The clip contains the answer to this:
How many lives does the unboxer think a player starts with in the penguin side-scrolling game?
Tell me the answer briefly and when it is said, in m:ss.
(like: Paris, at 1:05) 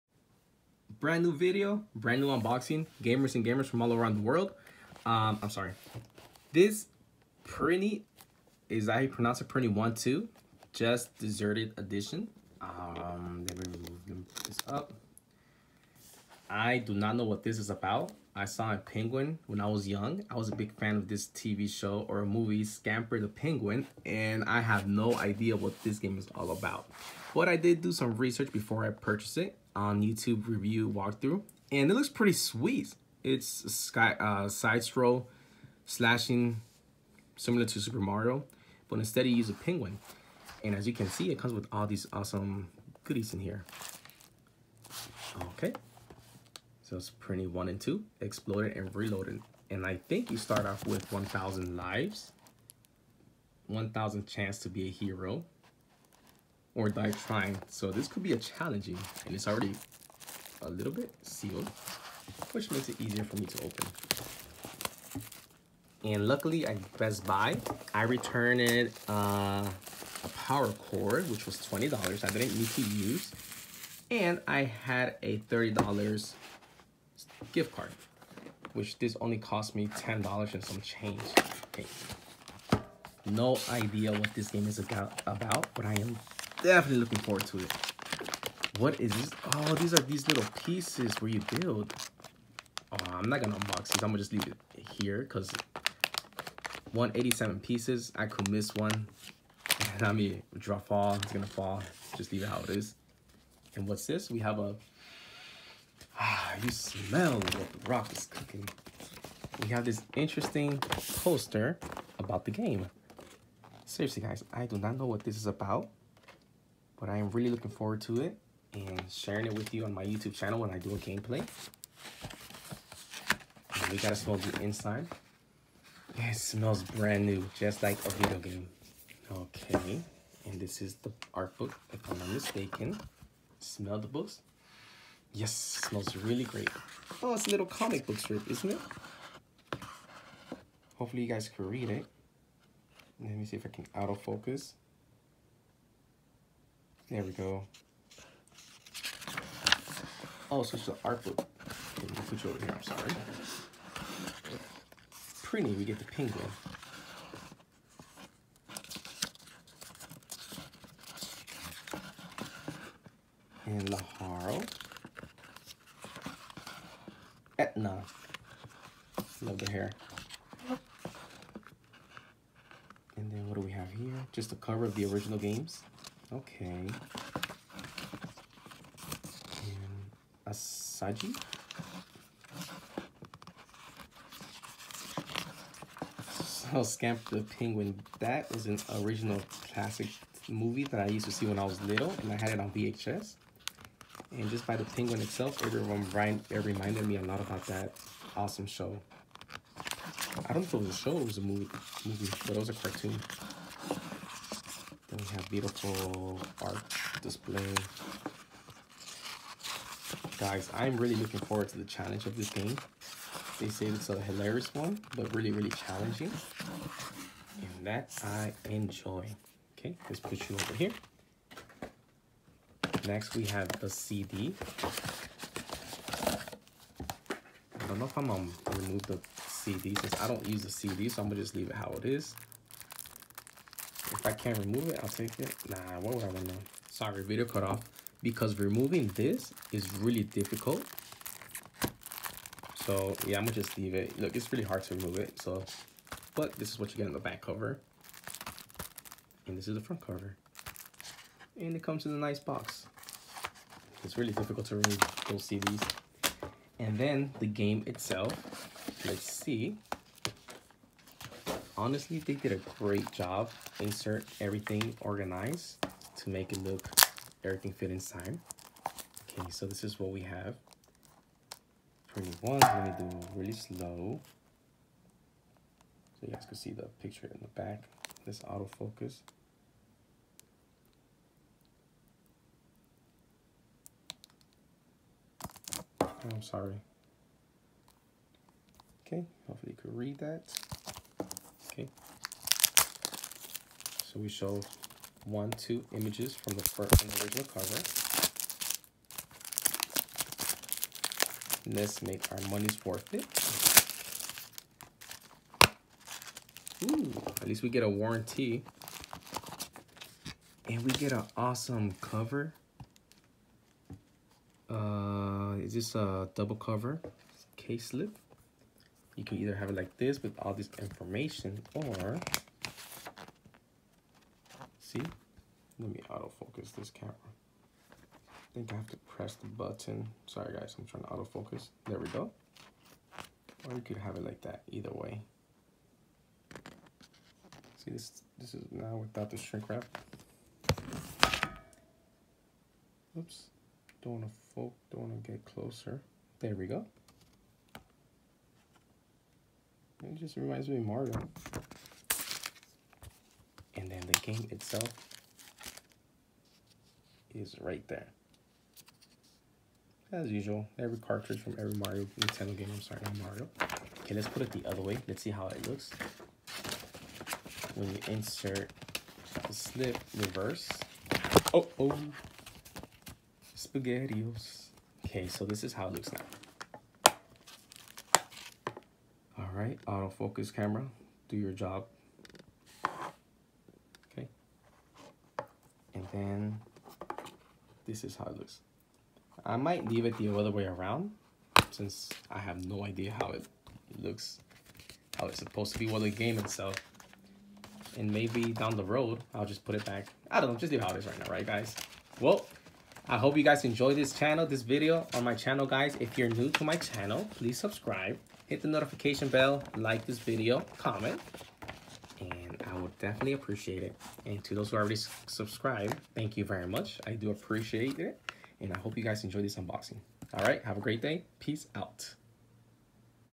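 1,000, at 0:51.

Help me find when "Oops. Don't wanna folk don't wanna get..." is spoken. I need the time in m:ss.
5:43.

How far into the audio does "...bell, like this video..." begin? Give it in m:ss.
6:49.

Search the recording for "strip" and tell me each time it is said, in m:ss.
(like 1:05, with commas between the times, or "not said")
2:18.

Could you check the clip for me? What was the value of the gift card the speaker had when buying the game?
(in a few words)
$30.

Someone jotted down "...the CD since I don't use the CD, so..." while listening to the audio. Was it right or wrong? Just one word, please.
right.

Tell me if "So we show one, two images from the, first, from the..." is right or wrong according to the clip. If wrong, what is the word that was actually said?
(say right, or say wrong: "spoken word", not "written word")
right.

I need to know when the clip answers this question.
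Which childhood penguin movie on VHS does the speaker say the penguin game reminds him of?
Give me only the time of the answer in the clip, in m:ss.
0:22.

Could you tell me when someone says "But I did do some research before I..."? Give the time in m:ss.
0:27.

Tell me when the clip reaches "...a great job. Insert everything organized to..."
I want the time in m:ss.
4:22.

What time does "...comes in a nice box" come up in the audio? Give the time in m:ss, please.
4:11.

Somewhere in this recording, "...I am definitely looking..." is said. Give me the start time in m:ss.
1:25.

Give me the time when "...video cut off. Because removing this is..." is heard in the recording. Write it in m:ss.
3:57.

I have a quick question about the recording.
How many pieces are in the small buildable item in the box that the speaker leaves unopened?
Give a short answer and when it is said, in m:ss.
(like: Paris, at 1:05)
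187, at 1:36.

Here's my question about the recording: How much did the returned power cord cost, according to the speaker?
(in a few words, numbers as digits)
$20.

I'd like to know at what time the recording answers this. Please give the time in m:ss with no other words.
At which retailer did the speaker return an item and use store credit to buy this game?
1:06.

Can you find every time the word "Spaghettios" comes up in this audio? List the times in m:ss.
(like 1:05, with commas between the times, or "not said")
6:13.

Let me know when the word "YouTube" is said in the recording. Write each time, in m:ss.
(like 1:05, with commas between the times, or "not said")
0:30, 2:00.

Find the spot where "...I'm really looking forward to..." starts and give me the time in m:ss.
3:30.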